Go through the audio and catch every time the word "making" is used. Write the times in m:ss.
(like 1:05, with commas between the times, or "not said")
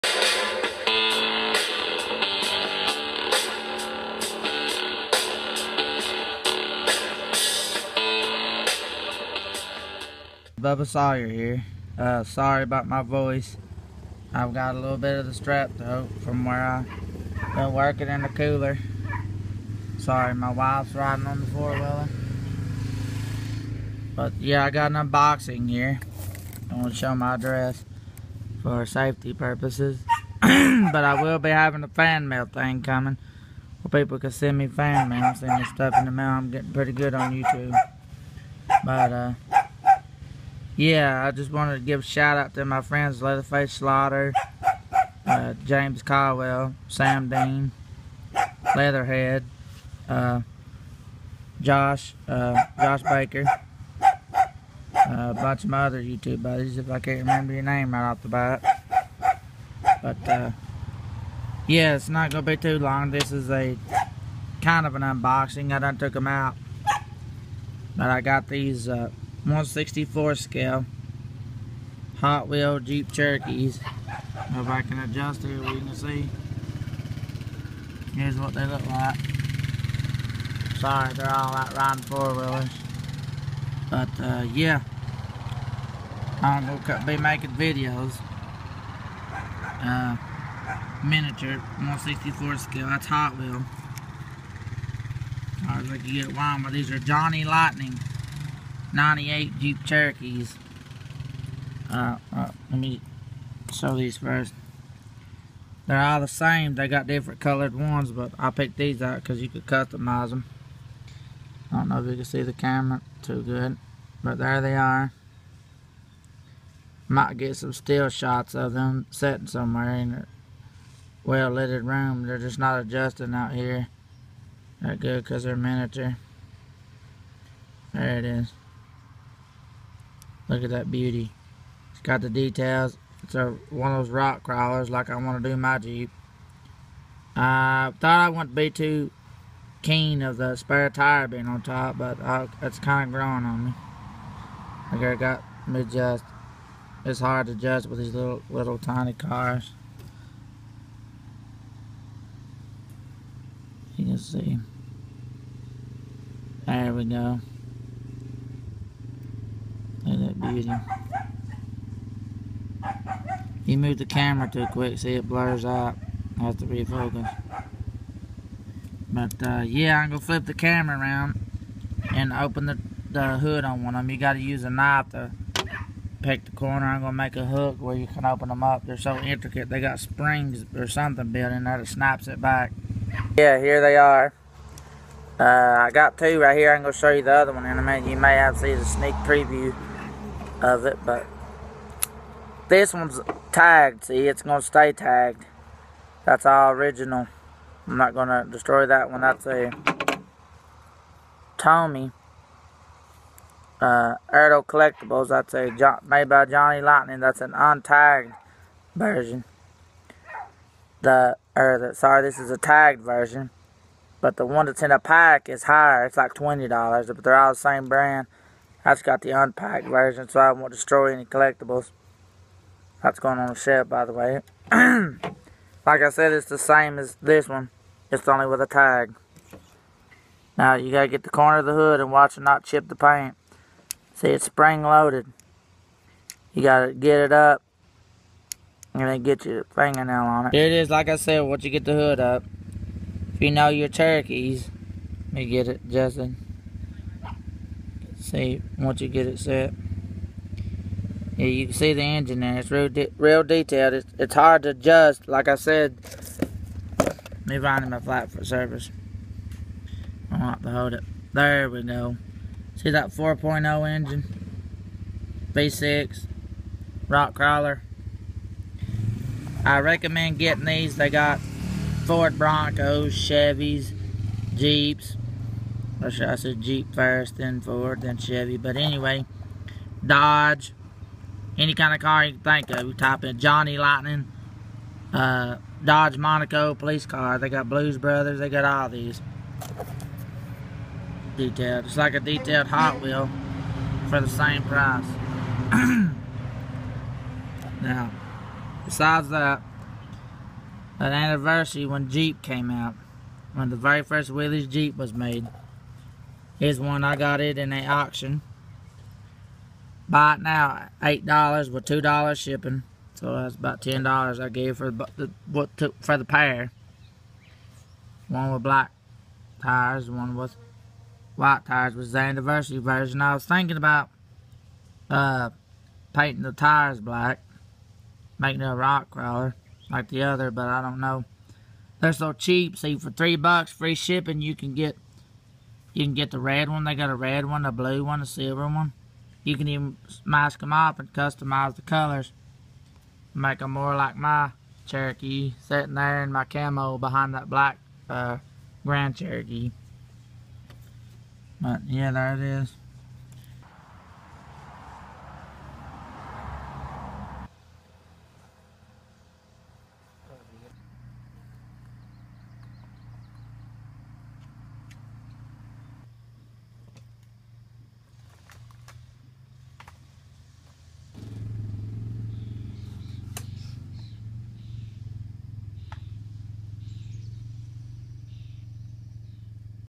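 1:27, 5:28.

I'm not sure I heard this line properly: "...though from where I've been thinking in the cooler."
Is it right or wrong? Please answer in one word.
wrong.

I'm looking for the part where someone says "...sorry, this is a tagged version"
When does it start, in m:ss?
3:31.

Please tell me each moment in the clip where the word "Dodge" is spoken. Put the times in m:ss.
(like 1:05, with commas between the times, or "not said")
4:40, 4:45.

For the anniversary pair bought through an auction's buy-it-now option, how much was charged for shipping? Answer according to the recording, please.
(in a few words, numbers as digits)
$2.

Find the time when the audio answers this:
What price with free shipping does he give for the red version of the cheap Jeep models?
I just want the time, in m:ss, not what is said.
5:33.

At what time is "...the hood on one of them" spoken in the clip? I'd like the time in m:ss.
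2:53.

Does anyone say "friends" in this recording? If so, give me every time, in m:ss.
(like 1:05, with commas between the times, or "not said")
0:42.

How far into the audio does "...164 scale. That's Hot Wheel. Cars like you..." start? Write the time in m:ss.
1:31.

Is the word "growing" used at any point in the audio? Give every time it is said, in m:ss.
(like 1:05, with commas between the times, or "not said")
2:23.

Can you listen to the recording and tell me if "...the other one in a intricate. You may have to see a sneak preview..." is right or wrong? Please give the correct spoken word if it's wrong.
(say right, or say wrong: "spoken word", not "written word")
wrong: "minute", not "intricate".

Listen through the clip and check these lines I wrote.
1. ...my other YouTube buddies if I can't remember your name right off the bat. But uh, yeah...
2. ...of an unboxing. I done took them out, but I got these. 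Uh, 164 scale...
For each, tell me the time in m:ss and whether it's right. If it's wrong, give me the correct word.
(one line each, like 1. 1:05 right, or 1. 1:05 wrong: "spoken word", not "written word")
1. 0:55 right
2. 1:04 right.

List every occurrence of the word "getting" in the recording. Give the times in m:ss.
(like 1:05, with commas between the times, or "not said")
0:36, 4:30.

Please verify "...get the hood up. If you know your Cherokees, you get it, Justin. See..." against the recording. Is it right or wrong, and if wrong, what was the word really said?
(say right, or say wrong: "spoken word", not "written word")
right.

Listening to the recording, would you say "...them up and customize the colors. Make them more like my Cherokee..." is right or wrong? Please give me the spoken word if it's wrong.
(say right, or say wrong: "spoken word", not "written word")
right.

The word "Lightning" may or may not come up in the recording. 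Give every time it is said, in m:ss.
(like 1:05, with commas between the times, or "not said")
1:37, 3:26, 4:43.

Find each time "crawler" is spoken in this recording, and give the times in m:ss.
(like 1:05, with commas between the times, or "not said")
2:14, 4:27, 5:29.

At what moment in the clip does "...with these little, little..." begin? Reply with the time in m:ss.
2:27.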